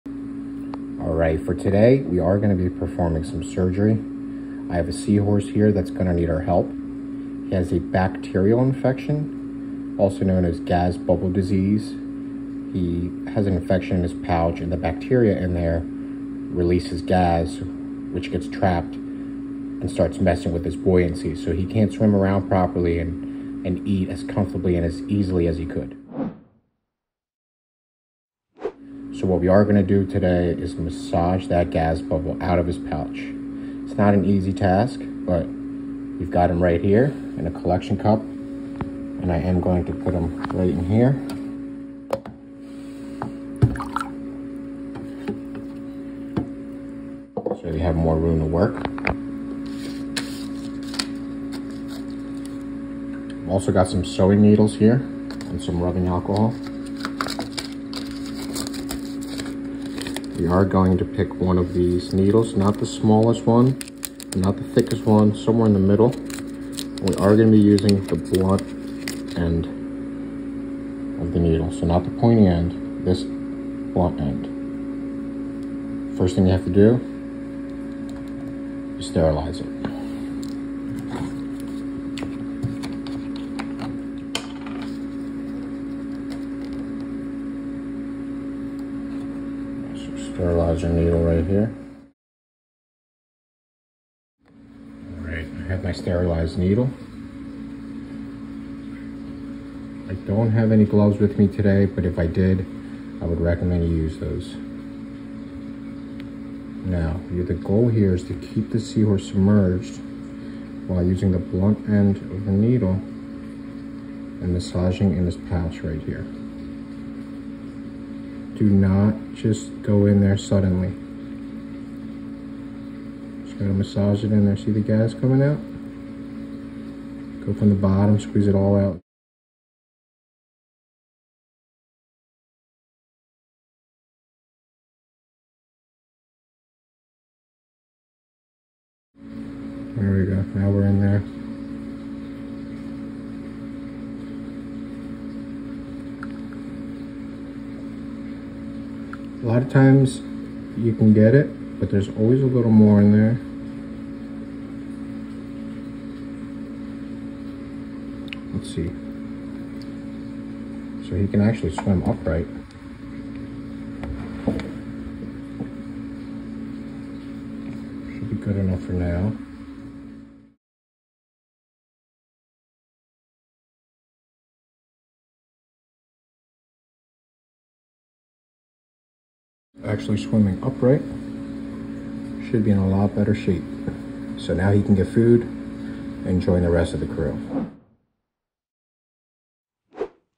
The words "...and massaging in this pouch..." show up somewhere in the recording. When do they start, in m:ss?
1:54.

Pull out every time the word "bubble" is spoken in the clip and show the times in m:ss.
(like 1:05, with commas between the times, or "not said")
0:10, 0:32.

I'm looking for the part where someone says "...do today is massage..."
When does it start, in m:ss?
0:29.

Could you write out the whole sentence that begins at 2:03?
Just gotta massage it in there.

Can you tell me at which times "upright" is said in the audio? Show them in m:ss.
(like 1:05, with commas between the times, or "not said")
2:42, 3:00.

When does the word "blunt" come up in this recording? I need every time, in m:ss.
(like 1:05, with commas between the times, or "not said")
1:08, 1:13, 1:51.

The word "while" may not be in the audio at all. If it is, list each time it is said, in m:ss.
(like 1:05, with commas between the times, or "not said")
1:50.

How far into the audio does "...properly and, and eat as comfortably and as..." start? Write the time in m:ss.
0:22.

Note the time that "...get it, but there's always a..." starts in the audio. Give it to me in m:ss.
2:31.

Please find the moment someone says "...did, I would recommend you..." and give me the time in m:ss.
1:42.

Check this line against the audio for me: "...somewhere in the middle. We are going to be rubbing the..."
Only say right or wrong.
wrong.